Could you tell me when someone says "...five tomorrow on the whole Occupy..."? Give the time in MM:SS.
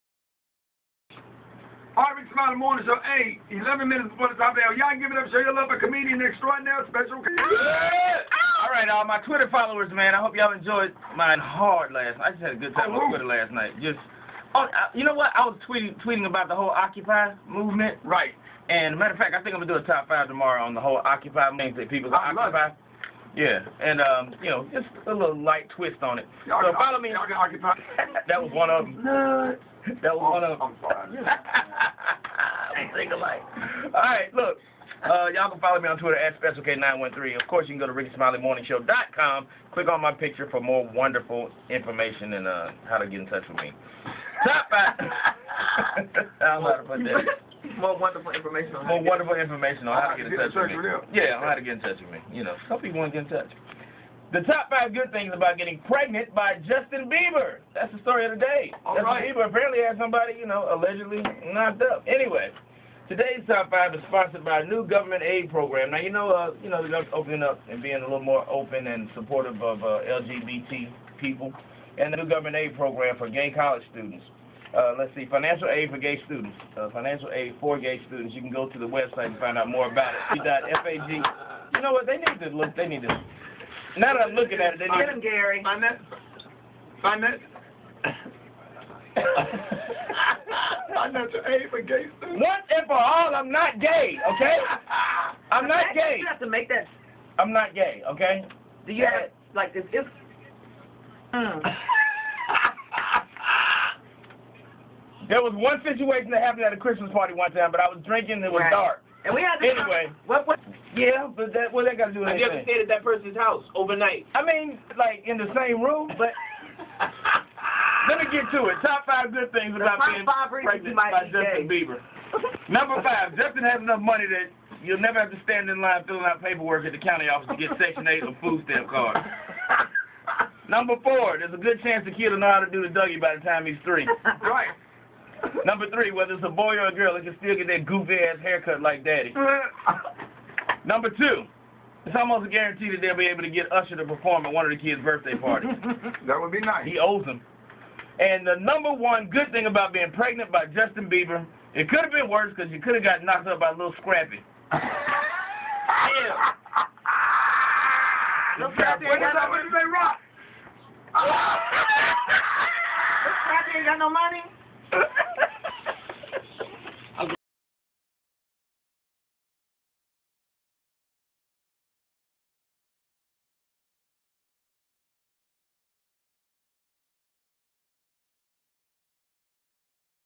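00:20.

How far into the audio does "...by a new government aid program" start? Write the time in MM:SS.
01:04.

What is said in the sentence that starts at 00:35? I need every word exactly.
Uh, y'all can follow me on Twitter at SpecialK913.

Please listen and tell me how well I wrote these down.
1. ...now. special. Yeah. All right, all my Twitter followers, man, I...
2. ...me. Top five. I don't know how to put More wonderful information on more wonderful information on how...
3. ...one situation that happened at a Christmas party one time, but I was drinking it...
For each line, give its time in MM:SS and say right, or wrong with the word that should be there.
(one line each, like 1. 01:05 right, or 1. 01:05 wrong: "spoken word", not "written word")
1. 00:06 right
2. 00:43 right
3. 01:45 right.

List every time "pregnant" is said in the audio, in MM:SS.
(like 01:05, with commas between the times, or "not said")
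00:55, 02:00, 02:30.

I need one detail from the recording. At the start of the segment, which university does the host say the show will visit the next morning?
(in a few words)
Harvard.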